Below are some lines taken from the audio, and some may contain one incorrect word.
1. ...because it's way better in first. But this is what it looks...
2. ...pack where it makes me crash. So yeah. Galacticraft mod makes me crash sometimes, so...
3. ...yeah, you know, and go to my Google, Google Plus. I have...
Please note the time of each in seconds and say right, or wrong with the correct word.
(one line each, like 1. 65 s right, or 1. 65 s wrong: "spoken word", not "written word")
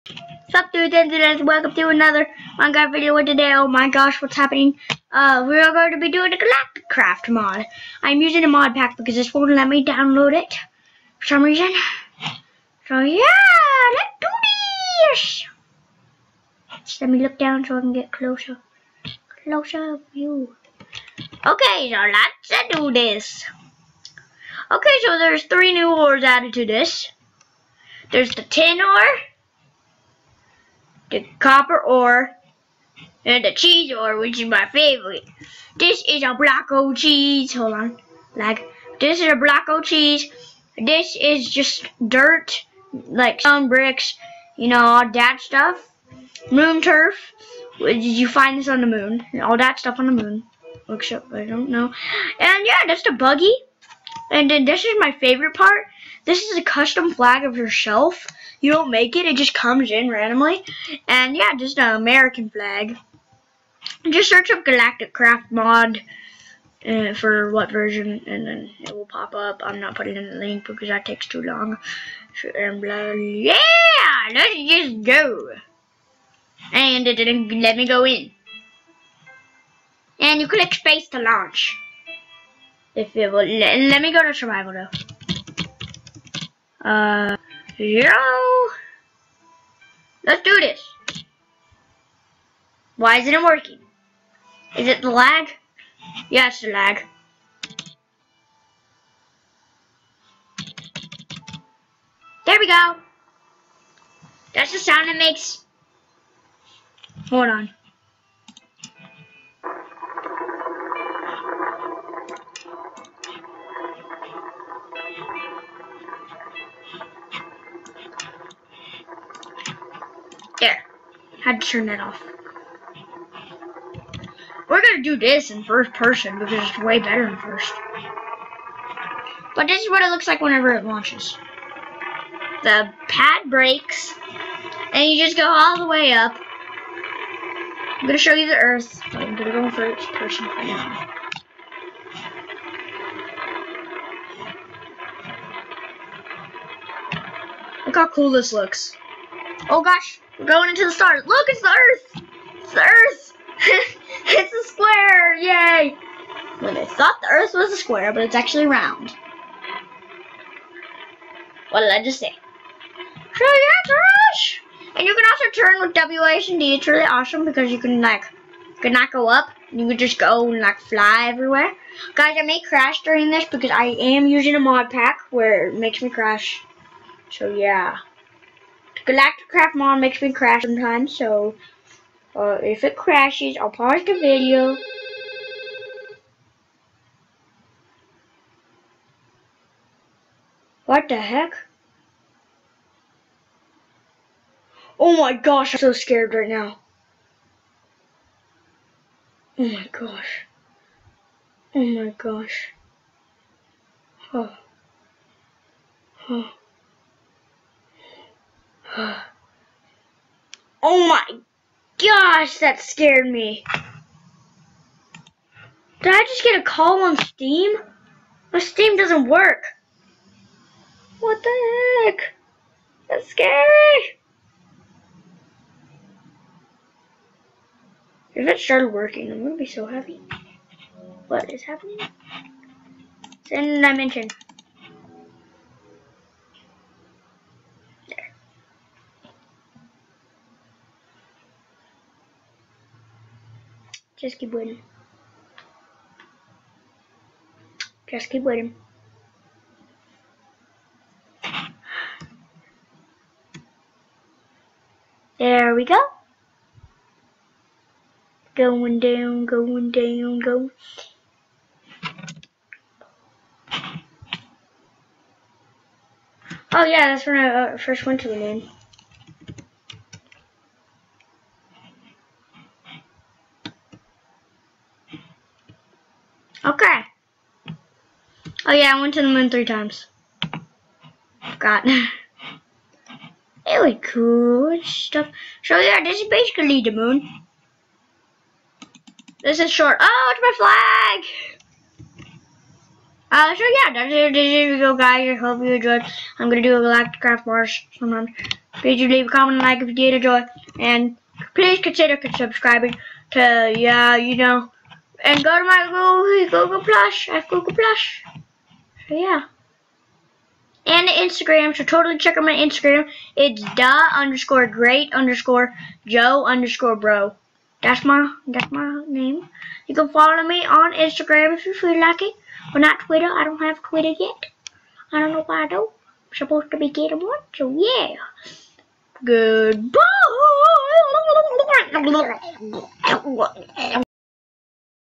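1. 126 s right
2. 174 s right
3. 303 s right.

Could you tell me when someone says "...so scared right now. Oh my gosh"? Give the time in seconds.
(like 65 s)
195 s.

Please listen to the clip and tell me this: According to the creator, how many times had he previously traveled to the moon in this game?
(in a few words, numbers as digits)
3.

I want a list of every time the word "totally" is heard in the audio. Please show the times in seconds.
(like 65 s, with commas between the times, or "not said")
311 s.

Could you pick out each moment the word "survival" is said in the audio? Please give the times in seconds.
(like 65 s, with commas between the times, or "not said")
84 s.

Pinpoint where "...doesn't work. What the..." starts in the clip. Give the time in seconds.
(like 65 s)
218 s.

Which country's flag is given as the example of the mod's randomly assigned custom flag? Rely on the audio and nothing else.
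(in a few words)
American.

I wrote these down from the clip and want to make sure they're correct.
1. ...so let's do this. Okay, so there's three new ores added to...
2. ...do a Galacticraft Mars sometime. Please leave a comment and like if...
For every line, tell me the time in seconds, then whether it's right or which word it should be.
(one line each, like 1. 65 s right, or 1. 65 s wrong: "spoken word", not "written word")
1. 21 s right
2. 296 s right.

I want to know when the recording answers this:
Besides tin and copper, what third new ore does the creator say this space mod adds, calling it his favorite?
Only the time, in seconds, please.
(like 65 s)
33 s.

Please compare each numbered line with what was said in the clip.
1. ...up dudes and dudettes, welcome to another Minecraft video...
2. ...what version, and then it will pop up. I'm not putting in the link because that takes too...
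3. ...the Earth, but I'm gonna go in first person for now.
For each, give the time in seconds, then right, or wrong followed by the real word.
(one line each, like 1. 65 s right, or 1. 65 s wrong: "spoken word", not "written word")
1. 0 s right
2. 67 s right
3. 138 s right.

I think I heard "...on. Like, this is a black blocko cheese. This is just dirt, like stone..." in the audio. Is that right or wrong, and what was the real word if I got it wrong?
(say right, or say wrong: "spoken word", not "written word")
right.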